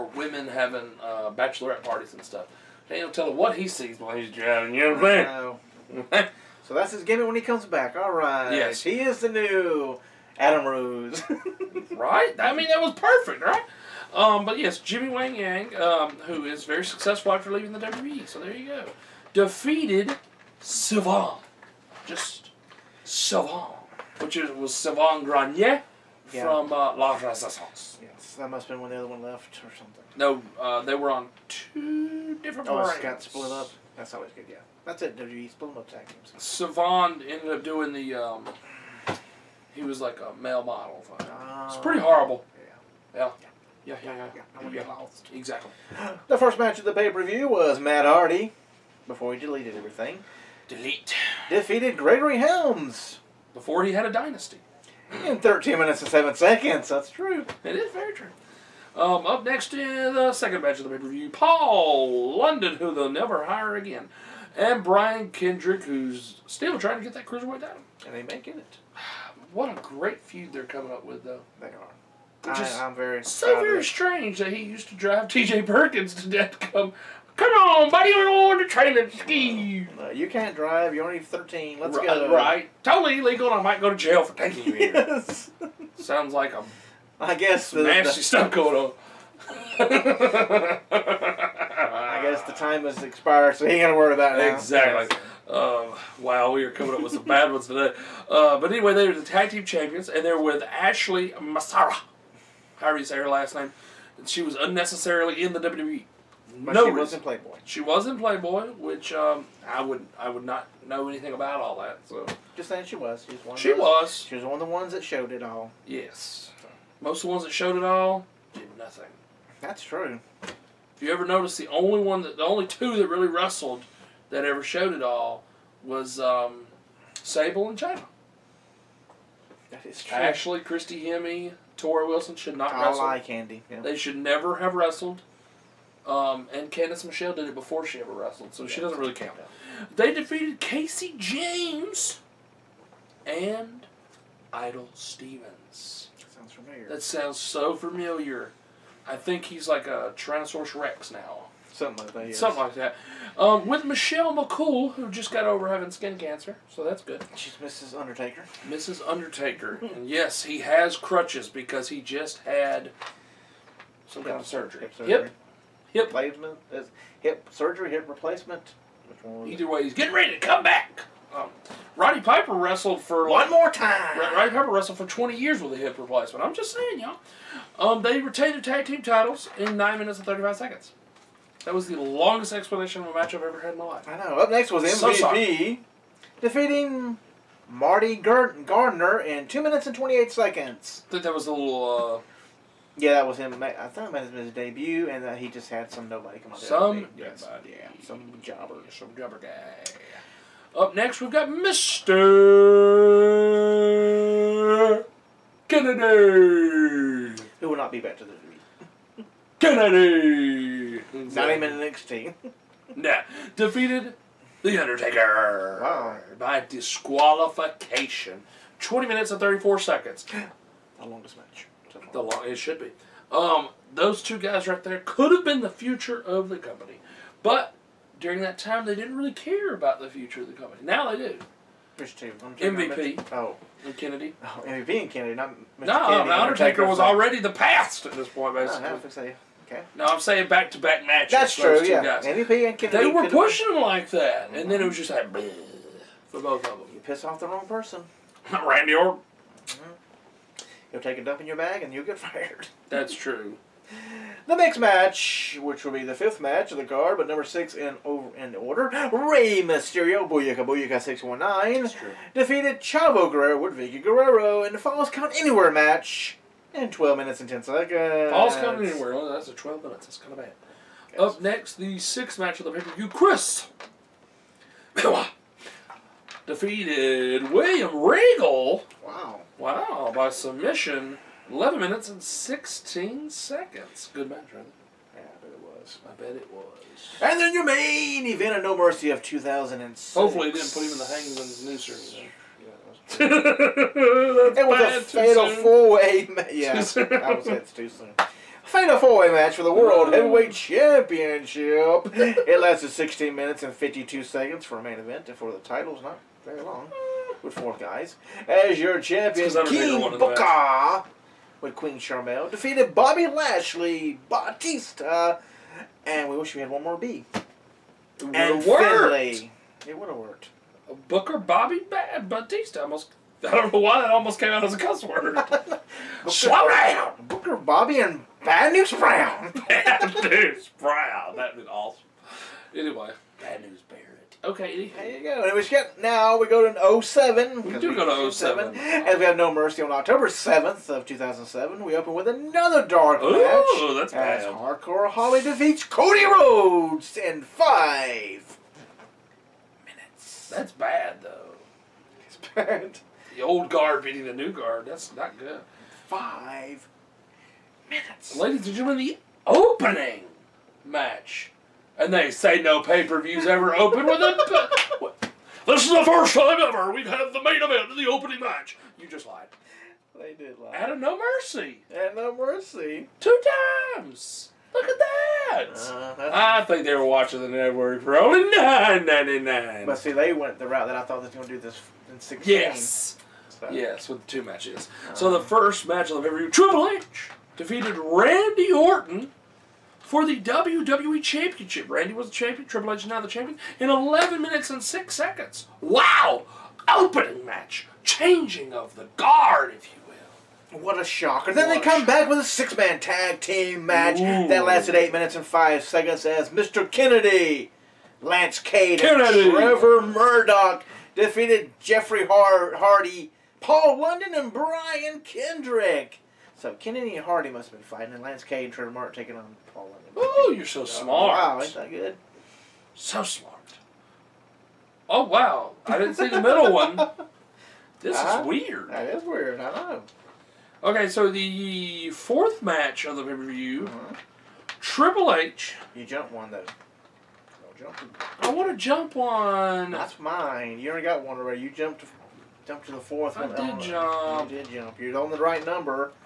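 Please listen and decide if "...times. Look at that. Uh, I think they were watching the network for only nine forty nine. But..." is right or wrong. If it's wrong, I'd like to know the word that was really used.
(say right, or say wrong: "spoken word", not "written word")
wrong: "ninety", not "forty".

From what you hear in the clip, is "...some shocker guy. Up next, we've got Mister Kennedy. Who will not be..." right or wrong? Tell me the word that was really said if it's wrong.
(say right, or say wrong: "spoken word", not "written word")
wrong: "jobber", not "shocker".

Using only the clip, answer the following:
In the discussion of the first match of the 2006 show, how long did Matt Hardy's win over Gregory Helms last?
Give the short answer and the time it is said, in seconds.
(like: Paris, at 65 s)
13 minutes and 7 seconds, at 55 s.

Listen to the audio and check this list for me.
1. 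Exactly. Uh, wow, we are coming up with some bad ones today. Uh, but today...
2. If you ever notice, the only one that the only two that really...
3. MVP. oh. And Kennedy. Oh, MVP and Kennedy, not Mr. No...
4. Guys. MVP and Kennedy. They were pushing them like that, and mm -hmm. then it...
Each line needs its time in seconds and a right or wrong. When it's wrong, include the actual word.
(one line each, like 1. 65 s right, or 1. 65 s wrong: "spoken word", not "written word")
1. 94 s wrong: "anyway", not "today"
2. 120 s right
3. 232 s right
4. 242 s right.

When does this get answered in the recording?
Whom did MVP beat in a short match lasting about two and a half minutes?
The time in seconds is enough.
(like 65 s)
187 s.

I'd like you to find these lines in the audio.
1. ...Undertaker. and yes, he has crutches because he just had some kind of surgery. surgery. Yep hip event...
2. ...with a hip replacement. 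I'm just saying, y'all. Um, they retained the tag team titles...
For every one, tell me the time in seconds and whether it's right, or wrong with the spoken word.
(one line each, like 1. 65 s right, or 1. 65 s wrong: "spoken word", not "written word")
1. 159 s wrong: "replacement", not "event"
2. 175 s right.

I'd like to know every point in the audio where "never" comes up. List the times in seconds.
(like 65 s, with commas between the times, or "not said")
63 s, 134 s.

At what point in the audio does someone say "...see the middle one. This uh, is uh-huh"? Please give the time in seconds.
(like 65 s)
426 s.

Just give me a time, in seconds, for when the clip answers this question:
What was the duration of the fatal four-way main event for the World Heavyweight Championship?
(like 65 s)
302 s.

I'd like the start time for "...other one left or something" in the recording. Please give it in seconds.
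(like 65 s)
28 s.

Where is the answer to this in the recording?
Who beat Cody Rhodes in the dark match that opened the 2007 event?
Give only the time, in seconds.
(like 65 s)
344 s.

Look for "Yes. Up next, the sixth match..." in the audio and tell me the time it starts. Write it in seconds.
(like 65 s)
271 s.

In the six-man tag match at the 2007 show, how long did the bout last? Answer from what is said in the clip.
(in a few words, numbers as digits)
8 minutes and 5 seconds.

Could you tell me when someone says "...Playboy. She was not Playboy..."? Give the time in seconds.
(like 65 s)
107 s.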